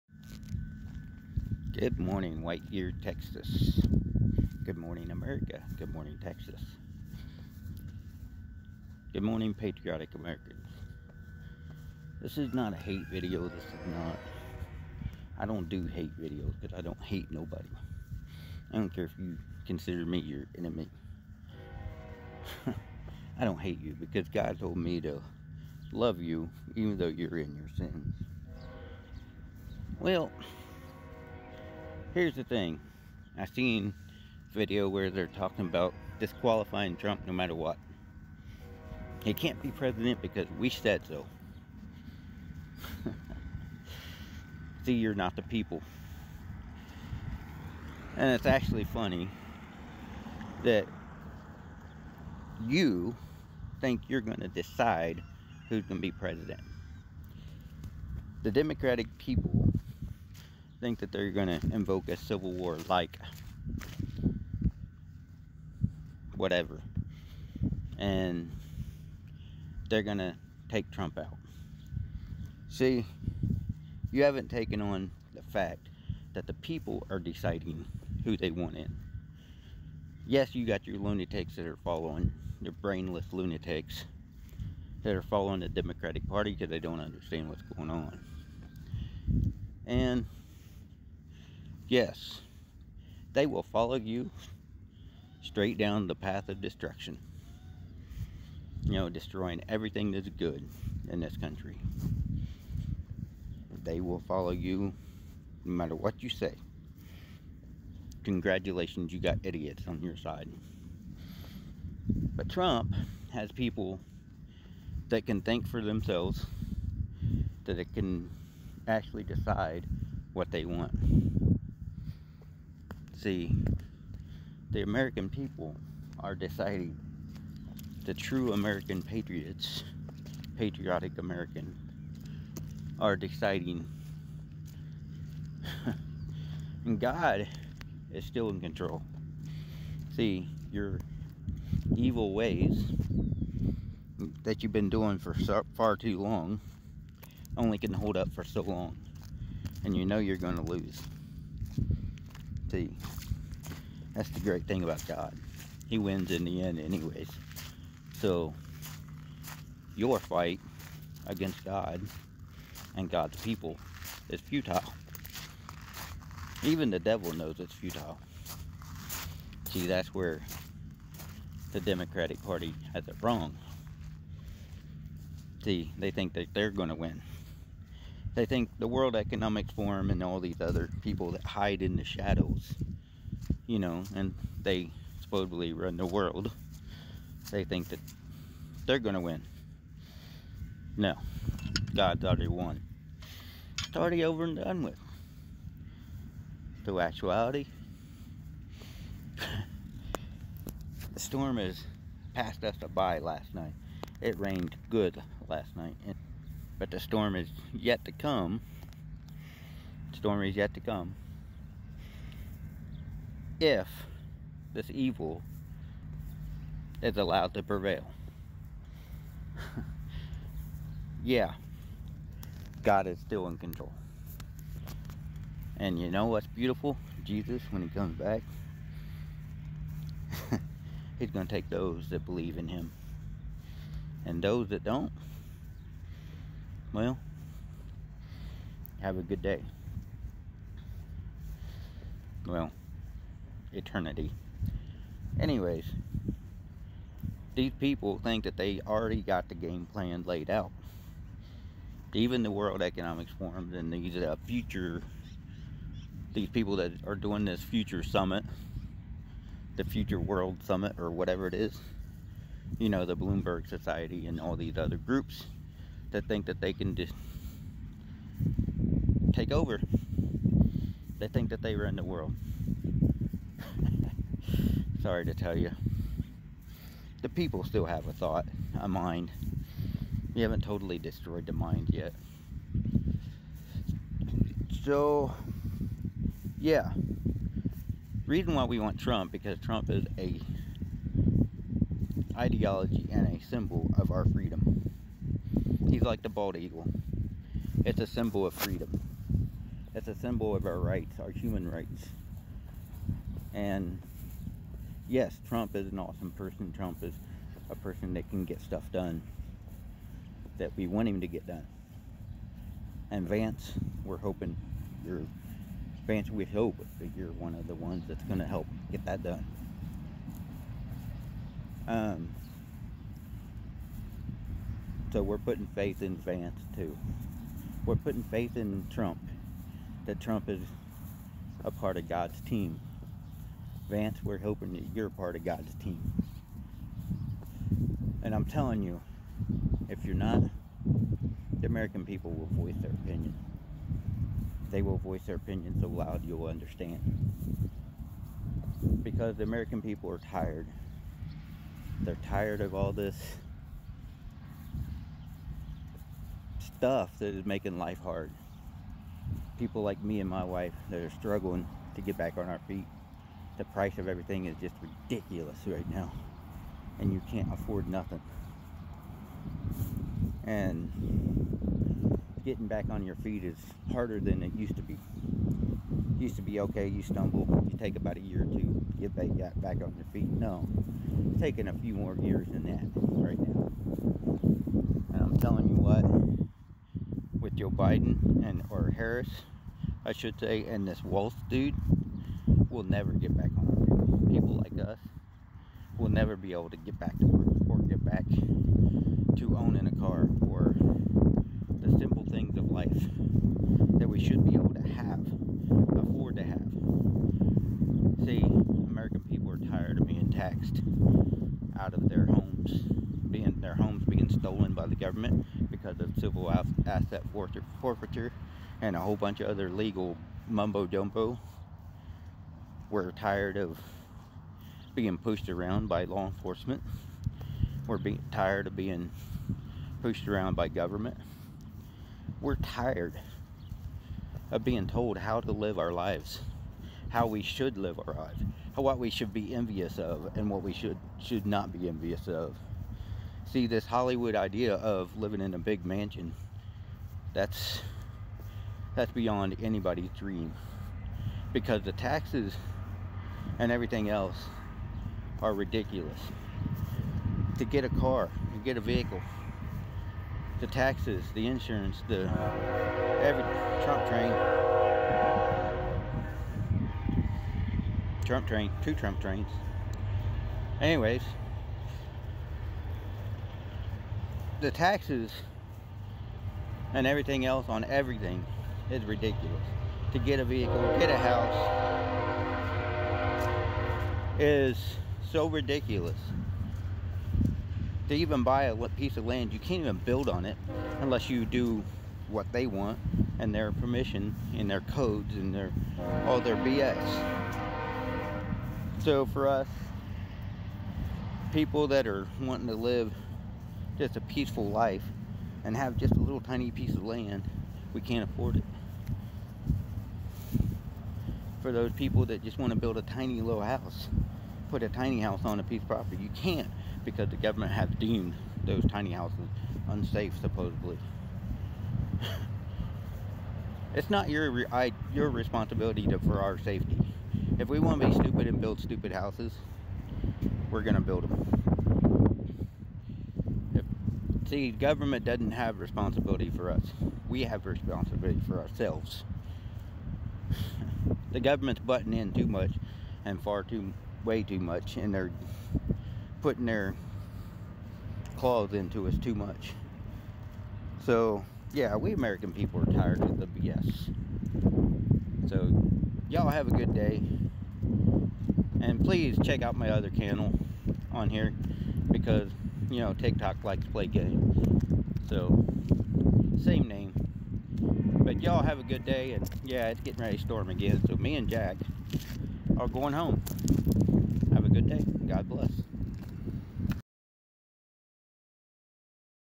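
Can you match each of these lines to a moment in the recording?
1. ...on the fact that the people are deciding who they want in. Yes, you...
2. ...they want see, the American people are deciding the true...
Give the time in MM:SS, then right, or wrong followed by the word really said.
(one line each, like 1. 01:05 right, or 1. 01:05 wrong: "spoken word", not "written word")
1. 01:14 right
2. 02:00 right.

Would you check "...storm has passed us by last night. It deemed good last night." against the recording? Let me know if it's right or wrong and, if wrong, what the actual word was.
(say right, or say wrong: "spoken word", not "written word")
wrong: "rained", not "deemed".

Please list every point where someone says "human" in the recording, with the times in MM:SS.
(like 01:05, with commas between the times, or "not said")
05:01.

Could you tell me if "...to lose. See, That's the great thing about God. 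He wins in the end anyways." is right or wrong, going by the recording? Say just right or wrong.
right.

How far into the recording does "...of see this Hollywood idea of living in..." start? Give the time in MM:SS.
07:22.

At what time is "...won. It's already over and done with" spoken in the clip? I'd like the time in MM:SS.
03:12.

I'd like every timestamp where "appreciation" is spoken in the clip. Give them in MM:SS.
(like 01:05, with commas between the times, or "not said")
not said.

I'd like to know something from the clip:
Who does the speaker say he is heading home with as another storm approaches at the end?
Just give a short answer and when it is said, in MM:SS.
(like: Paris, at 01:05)
Jack, at 09:31.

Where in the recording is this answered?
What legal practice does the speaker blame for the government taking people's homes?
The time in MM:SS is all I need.
06:56.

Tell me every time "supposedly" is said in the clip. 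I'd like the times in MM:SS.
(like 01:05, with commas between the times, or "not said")
03:05, 08:40.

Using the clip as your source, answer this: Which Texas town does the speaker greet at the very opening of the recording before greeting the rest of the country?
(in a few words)
White Whiteyear.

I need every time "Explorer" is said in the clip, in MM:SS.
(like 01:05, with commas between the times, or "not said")
not said.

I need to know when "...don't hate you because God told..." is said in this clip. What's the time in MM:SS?
00:23.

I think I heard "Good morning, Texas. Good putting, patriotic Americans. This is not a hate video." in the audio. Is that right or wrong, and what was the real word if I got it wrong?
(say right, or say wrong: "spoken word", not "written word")
wrong: "morning", not "putting".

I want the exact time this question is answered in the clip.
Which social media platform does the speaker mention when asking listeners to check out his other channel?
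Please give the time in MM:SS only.
09:23.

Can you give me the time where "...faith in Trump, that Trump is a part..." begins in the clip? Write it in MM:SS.
05:28.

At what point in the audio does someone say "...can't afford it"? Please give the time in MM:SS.
08:28.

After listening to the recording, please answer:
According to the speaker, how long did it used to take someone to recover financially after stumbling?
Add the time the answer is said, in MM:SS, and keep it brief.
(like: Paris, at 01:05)
a year or two, at 06:17.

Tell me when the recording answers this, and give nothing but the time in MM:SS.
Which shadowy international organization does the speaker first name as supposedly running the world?
02:58.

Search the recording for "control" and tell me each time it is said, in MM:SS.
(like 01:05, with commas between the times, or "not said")
02:18, 03:43.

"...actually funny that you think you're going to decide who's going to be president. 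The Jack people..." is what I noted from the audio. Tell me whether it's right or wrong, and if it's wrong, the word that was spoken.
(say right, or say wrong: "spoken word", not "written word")
wrong: "Democratic", not "Jack".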